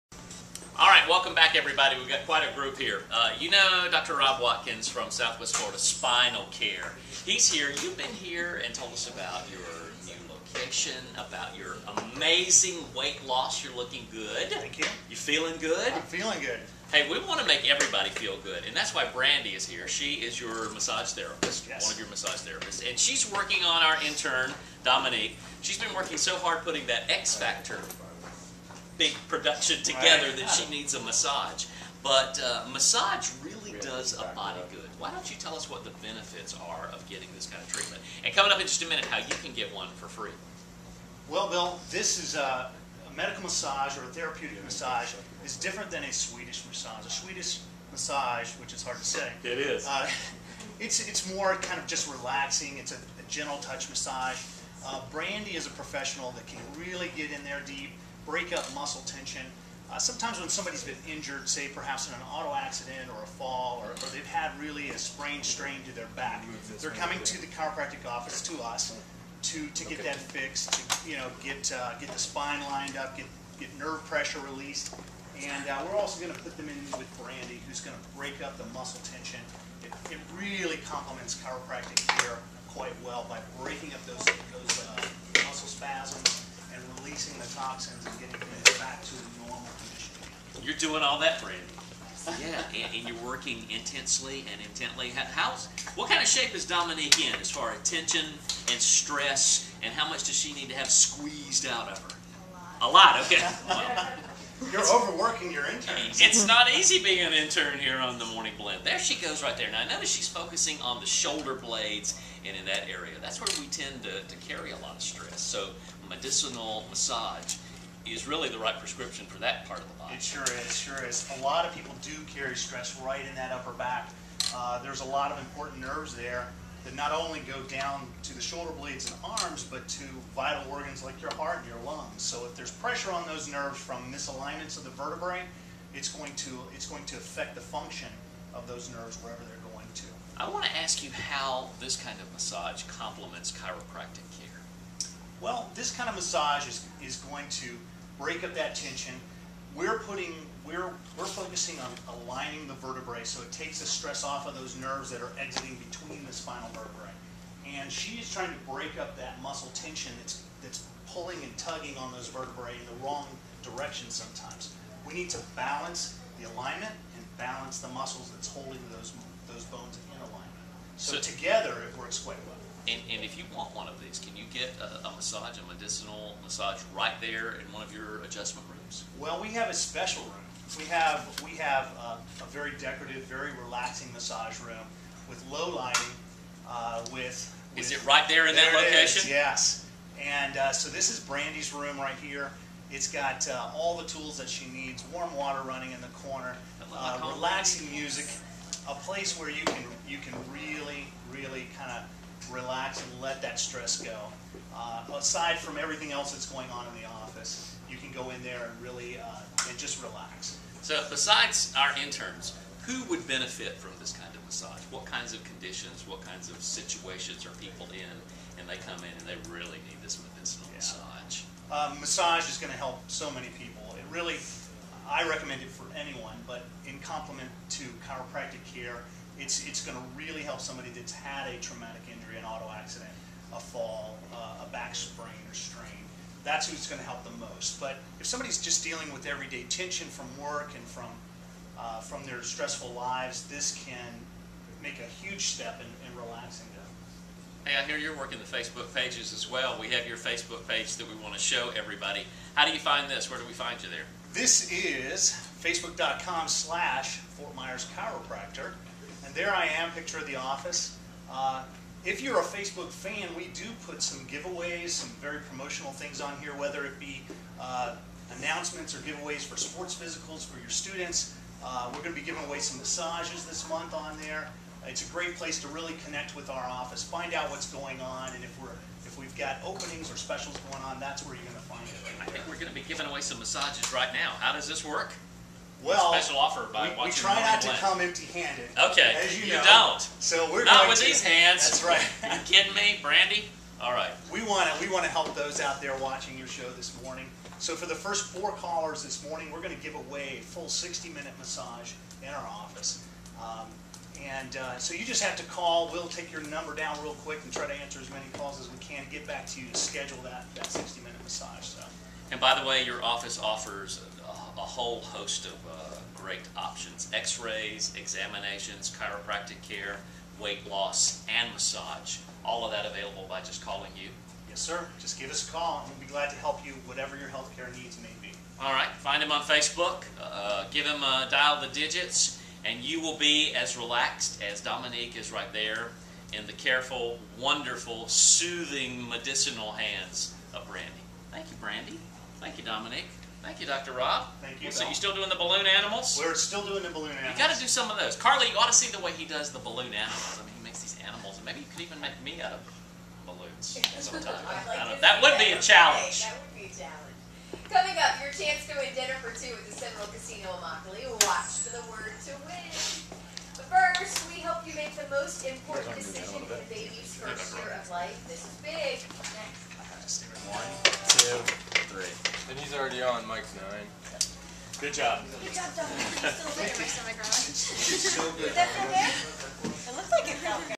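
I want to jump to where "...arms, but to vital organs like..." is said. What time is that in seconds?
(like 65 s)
129 s.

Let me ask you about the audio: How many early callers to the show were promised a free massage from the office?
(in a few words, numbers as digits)
4.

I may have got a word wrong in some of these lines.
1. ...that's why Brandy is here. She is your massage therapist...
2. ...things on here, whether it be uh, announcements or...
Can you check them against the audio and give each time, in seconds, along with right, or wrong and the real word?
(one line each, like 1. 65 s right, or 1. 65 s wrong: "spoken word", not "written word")
1. 18 s right
2. 265 s right.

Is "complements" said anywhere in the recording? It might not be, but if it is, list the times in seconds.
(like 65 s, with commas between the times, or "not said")
80 s, 142 s, 226 s.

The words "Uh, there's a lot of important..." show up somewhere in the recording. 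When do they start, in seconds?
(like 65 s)
124 s.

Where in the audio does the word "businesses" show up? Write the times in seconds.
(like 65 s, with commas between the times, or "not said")
not said.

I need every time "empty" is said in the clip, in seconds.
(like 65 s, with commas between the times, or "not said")
288 s.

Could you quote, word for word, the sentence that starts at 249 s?
We have your Facebook page that we want to show everybody.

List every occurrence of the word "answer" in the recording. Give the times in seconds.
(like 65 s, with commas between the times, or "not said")
307 s.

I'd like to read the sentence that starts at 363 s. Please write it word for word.
But first, we hope you make the most important decision in the baby's first year of life.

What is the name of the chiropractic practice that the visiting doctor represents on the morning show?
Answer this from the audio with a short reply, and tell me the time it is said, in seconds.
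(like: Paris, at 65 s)
Southwest Florida Spinal Care, at 5 s.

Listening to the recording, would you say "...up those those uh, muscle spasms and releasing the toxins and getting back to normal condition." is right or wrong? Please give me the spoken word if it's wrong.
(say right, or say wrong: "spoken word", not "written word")
right.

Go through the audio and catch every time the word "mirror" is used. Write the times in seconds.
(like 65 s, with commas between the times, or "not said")
not said.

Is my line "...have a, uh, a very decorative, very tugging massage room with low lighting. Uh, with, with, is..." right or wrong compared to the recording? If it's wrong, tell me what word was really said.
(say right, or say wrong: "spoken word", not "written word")
wrong: "relaxing", not "tugging".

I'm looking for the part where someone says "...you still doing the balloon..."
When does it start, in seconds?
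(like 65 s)
344 s.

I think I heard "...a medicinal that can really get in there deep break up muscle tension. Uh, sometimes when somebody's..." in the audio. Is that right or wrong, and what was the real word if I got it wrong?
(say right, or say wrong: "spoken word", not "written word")
wrong: "professional", not "medicinal".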